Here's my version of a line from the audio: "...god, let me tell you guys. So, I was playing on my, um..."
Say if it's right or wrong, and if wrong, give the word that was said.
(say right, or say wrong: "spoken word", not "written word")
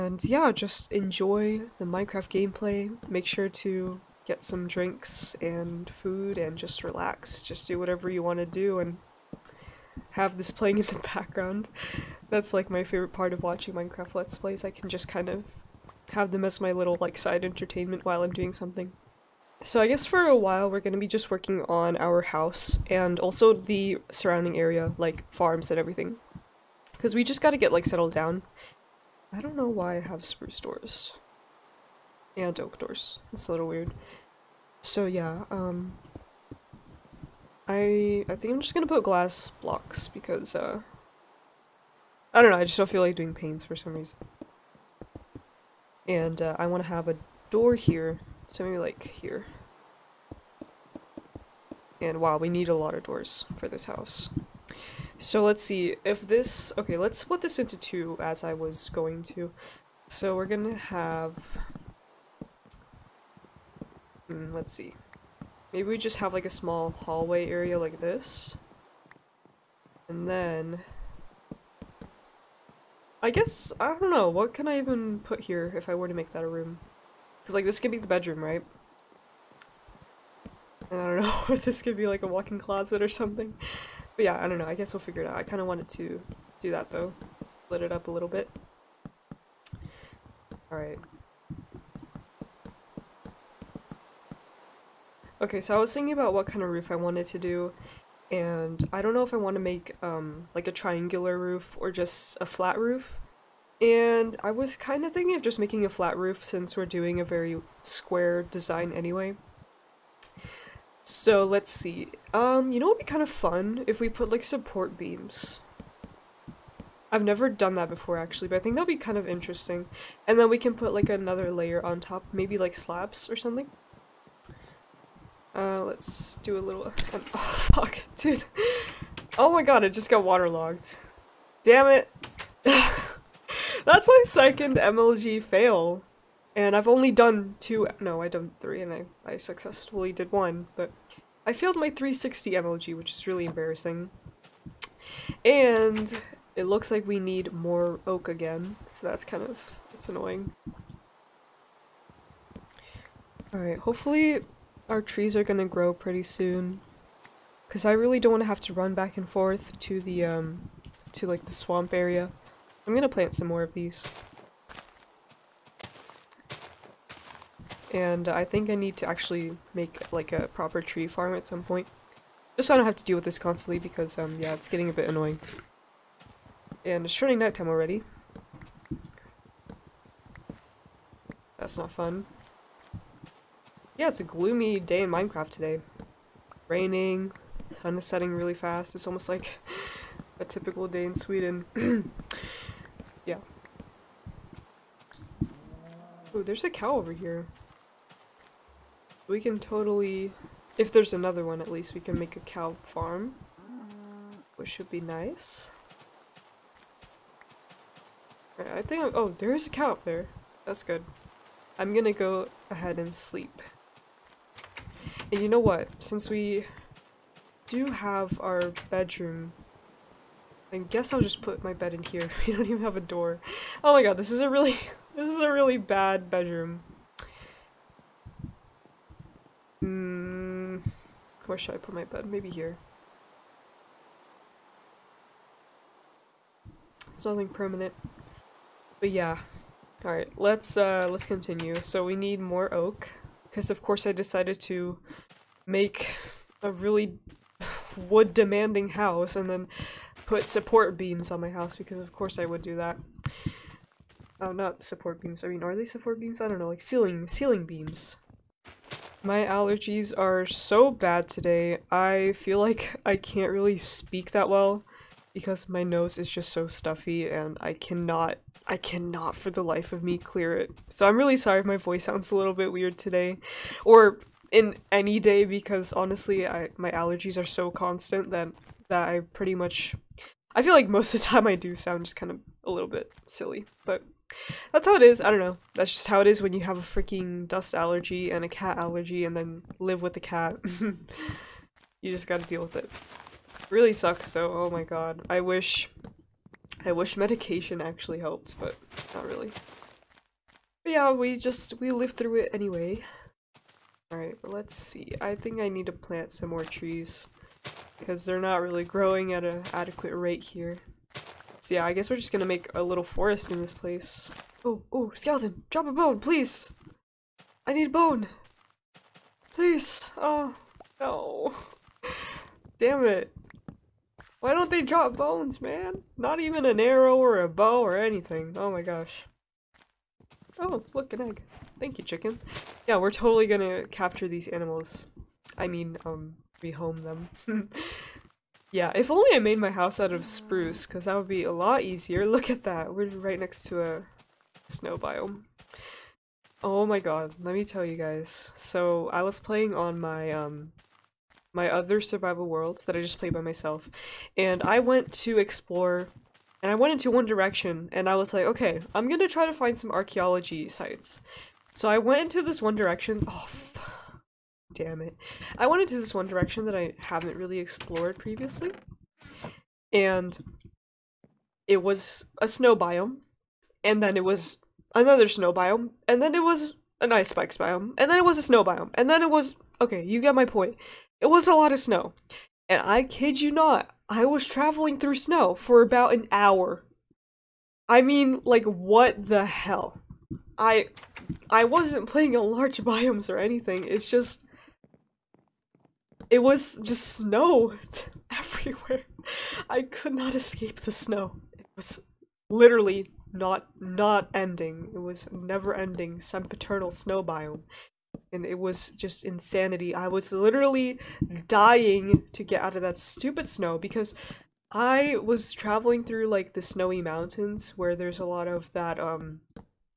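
right.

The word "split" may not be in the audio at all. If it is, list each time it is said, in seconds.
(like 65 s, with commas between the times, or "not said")
57 s, 87 s.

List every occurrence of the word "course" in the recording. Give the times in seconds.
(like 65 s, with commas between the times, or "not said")
243 s, 252 s.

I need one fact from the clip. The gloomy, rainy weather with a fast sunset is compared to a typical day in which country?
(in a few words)
Sweden.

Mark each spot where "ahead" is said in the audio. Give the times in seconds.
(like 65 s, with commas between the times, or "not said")
212 s.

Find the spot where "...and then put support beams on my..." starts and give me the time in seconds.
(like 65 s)
249 s.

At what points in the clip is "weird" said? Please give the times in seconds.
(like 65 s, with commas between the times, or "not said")
33 s, 272 s.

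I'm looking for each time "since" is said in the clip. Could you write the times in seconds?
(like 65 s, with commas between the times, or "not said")
106 s, 215 s.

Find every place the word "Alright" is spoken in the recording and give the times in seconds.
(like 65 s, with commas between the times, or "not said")
90 s, 153 s, 240 s, 304 s.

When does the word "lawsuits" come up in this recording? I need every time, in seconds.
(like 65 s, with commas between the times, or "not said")
not said.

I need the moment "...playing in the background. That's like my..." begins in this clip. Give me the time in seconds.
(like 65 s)
10 s.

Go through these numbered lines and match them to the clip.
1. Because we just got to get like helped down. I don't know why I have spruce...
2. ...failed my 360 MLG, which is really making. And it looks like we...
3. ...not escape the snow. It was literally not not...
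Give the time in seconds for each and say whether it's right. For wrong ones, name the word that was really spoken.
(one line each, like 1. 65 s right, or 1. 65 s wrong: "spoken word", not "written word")
1. 26 s wrong: "settled", not "helped"
2. 141 s wrong: "embarrassing", not "making"
3. 400 s right.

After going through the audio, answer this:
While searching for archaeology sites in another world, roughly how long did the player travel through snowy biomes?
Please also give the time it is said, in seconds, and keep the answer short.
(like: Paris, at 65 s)
an hour, at 386 s.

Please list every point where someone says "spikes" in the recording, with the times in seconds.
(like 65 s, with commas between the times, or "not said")
377 s.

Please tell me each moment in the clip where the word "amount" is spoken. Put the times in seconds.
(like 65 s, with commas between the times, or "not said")
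not said.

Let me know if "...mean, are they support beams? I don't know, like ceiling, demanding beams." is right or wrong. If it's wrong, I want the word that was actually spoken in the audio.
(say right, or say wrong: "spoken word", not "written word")
wrong: "ceiling", not "demanding".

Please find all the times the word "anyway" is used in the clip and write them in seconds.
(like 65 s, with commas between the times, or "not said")
108 s, 302 s.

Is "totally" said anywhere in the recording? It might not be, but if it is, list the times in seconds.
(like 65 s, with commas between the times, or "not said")
199 s, 333 s.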